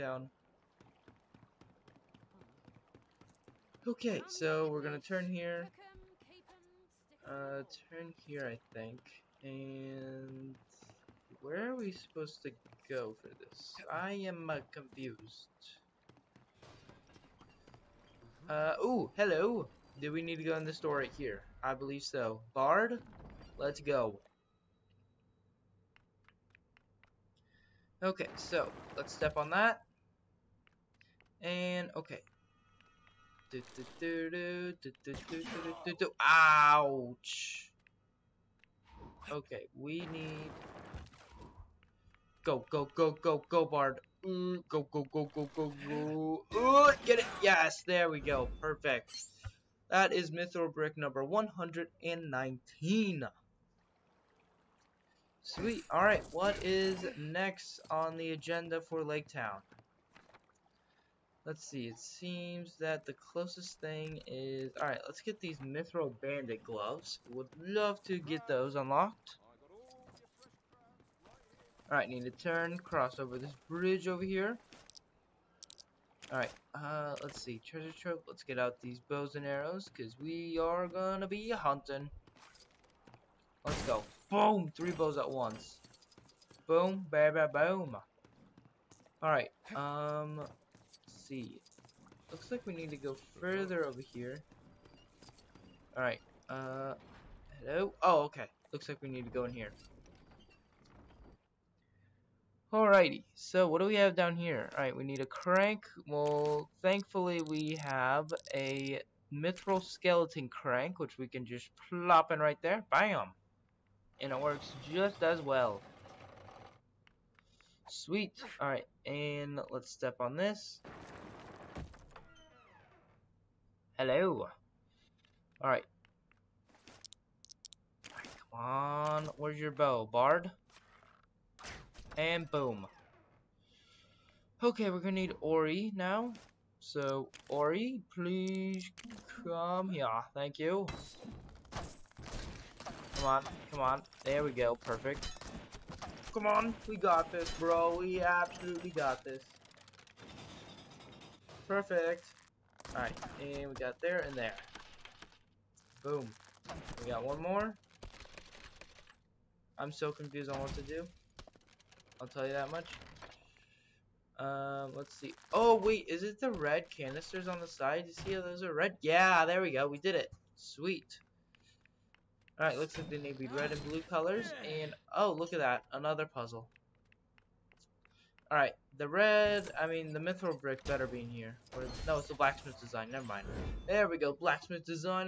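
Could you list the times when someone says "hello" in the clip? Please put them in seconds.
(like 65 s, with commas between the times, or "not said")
19 s, 97 s, 123 s.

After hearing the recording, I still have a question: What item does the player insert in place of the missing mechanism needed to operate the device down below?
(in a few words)
mithril skeleton crank.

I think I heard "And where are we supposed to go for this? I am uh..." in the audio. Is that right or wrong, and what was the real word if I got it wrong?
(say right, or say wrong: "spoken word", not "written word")
right.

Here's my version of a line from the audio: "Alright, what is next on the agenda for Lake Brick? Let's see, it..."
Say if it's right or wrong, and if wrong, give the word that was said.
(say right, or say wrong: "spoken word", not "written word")
wrong: "Town", not "Brick".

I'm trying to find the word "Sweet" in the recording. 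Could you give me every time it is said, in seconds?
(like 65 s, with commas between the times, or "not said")
55 s, 117 s, 170 s.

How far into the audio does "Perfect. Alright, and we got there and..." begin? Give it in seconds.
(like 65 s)
151 s.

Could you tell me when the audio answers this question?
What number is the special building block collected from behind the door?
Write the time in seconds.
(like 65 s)
50 s.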